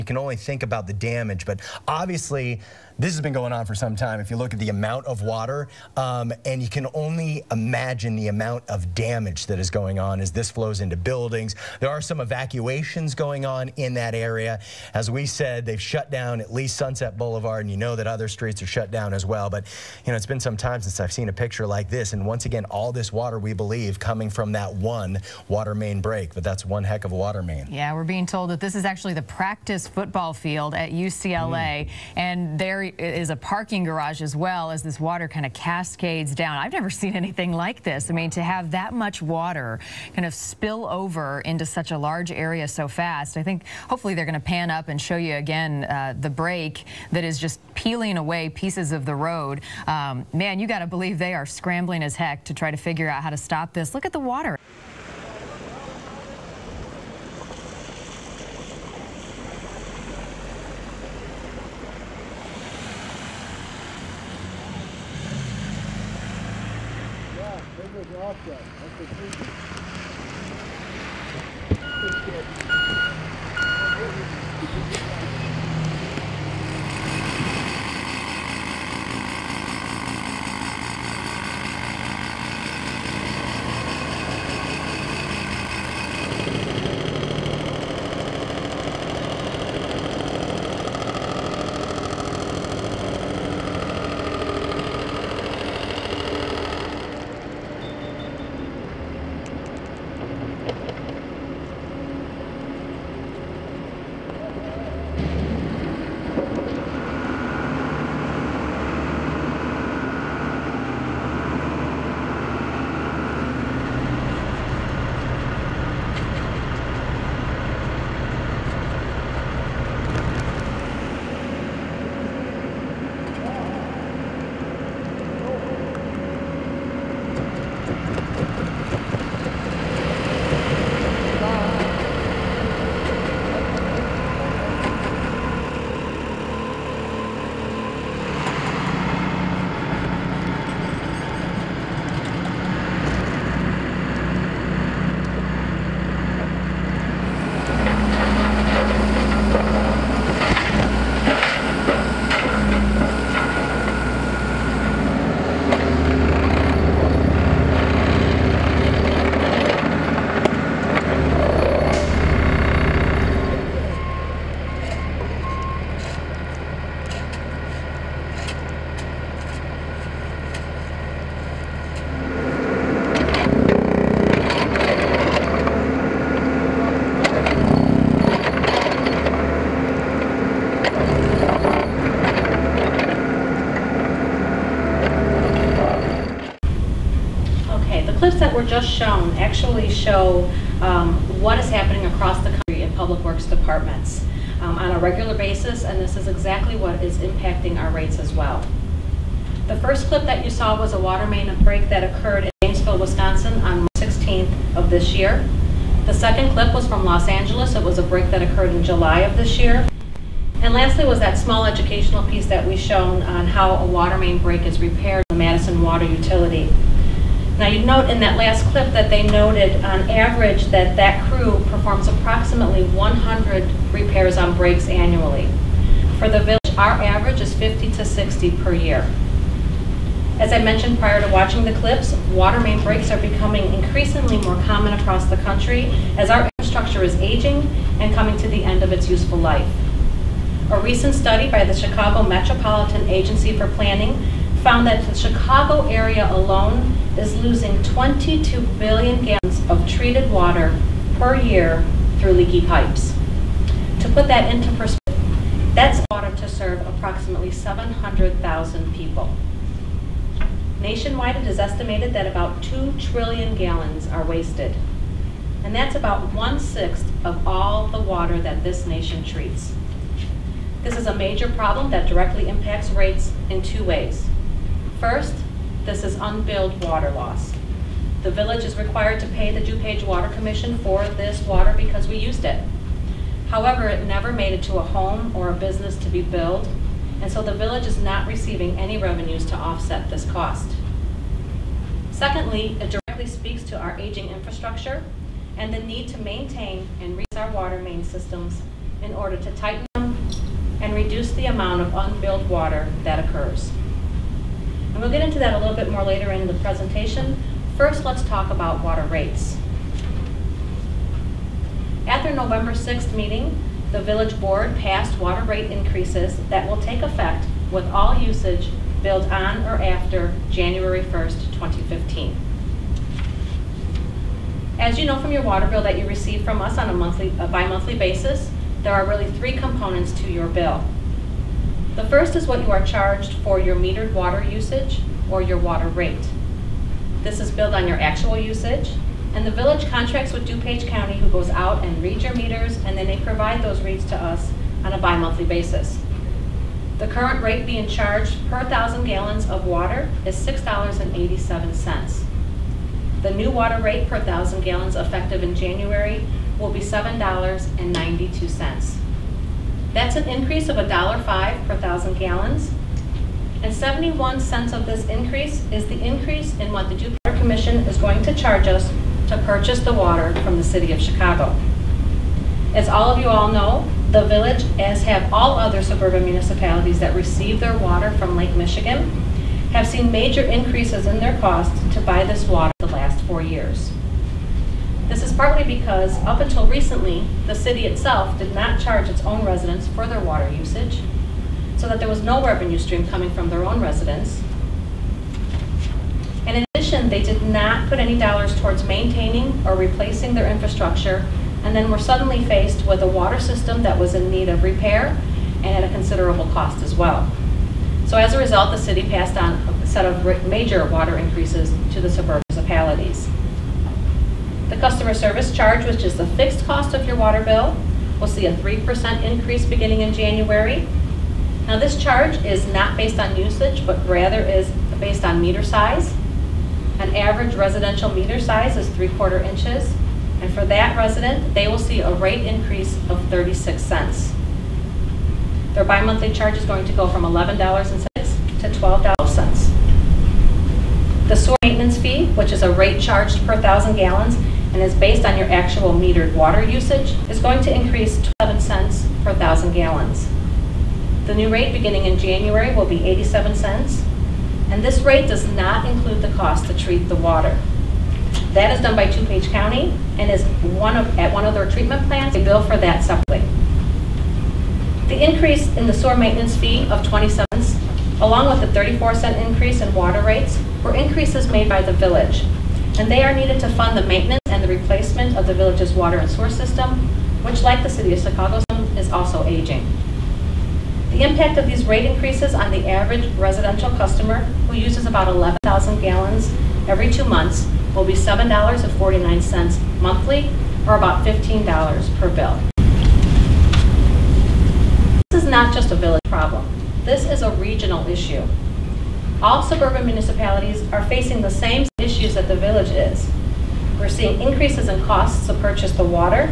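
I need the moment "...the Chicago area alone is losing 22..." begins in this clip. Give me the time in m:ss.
4:05.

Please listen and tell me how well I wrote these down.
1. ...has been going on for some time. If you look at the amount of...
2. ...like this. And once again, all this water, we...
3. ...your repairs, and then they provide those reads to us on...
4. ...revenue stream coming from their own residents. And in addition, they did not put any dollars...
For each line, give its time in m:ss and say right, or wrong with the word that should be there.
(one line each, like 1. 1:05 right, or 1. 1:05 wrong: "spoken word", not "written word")
1. 0:03 right
2. 0:21 right
3. 5:42 wrong: "meters", not "repairs"
4. 6:32 right.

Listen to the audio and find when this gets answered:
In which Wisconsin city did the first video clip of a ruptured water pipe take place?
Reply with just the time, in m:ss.
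3:22.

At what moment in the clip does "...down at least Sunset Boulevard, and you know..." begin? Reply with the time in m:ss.
0:16.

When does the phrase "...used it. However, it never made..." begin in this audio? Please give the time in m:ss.
4:42.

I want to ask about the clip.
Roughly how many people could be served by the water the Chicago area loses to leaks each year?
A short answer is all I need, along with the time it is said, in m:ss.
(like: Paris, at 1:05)
700,000, at 4:17.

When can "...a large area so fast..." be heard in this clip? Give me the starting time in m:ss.
0:41.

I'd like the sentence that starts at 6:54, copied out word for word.
The customer service charge, which is the fixed cost of your water bill, will see a 3% increase beginning in January.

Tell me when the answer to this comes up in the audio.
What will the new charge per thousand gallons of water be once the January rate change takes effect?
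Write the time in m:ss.
5:56.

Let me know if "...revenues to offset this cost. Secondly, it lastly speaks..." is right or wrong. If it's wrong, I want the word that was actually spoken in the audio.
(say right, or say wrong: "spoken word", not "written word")
wrong: "directly", not "lastly".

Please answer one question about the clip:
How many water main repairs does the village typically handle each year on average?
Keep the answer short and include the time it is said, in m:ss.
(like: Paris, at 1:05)
50 to 60, at 3:47.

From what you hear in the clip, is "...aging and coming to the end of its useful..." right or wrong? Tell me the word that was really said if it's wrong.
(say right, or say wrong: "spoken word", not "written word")
right.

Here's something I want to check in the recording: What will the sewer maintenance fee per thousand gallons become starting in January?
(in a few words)
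87 cents.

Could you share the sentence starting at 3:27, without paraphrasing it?
It was a break that occurred in July of this year.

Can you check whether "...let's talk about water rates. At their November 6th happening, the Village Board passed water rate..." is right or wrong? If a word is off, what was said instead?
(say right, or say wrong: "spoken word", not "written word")
wrong: "meeting", not "happening".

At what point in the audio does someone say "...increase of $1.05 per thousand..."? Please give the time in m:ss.
6:00.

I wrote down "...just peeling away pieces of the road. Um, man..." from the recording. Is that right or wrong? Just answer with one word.
right.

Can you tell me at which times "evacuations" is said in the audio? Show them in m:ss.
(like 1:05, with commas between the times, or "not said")
0:12.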